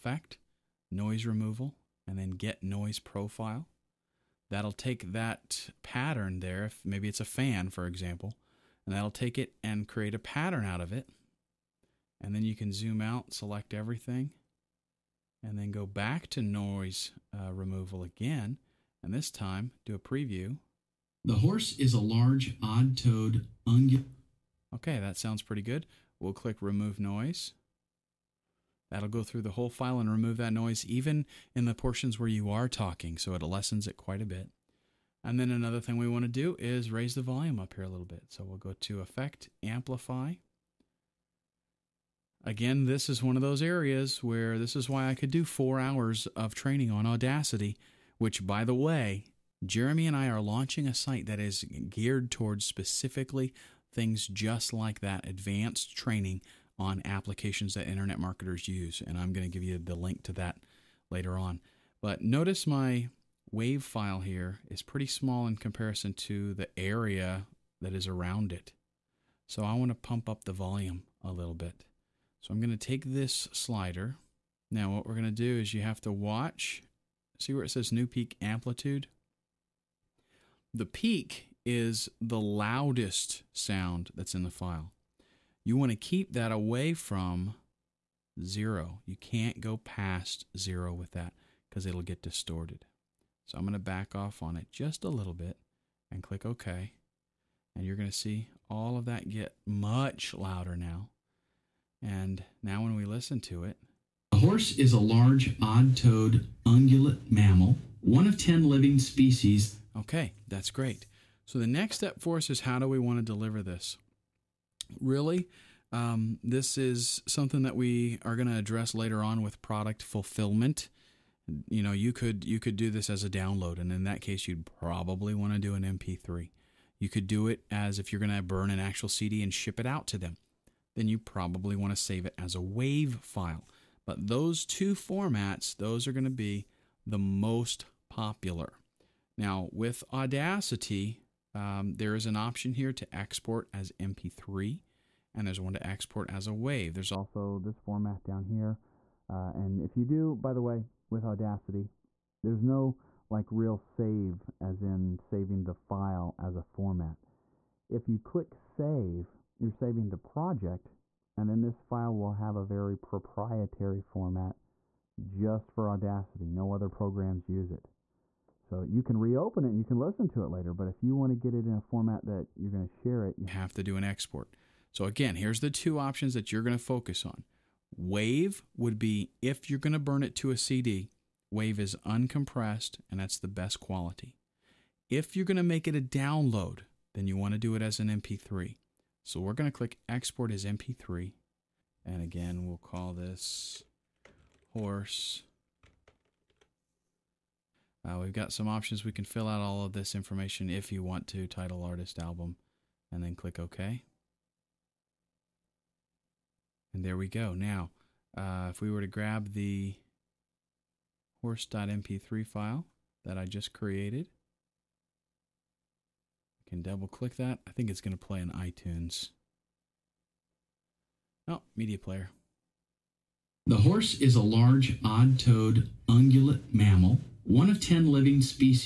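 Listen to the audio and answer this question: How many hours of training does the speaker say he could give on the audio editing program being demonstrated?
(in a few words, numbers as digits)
4.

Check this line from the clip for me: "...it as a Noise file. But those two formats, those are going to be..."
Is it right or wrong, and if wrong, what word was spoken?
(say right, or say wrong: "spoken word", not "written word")
wrong: "WAV", not "Noise".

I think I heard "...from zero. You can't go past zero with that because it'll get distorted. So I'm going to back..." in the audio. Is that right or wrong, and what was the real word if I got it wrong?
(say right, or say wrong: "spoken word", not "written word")
right.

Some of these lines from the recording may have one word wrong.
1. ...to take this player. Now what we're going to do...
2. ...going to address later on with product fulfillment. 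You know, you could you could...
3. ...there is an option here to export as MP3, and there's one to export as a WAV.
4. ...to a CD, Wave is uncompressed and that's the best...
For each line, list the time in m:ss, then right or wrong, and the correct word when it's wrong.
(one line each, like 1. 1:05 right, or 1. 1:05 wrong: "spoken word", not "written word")
1. 1:12 wrong: "slider", not "player"
2. 1:58 right
3. 2:21 right
4. 3:00 right.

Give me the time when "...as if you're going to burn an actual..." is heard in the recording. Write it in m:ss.
2:07.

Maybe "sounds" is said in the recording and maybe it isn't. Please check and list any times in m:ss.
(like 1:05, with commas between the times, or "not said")
0:25, 1:23.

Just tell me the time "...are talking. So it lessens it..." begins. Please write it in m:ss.
0:32.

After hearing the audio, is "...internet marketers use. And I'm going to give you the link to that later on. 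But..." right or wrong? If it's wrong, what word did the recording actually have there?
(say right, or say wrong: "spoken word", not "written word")
right.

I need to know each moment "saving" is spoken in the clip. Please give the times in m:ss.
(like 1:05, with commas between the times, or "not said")
2:35, 2:39.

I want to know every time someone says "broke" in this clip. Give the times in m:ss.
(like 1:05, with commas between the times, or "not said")
not said.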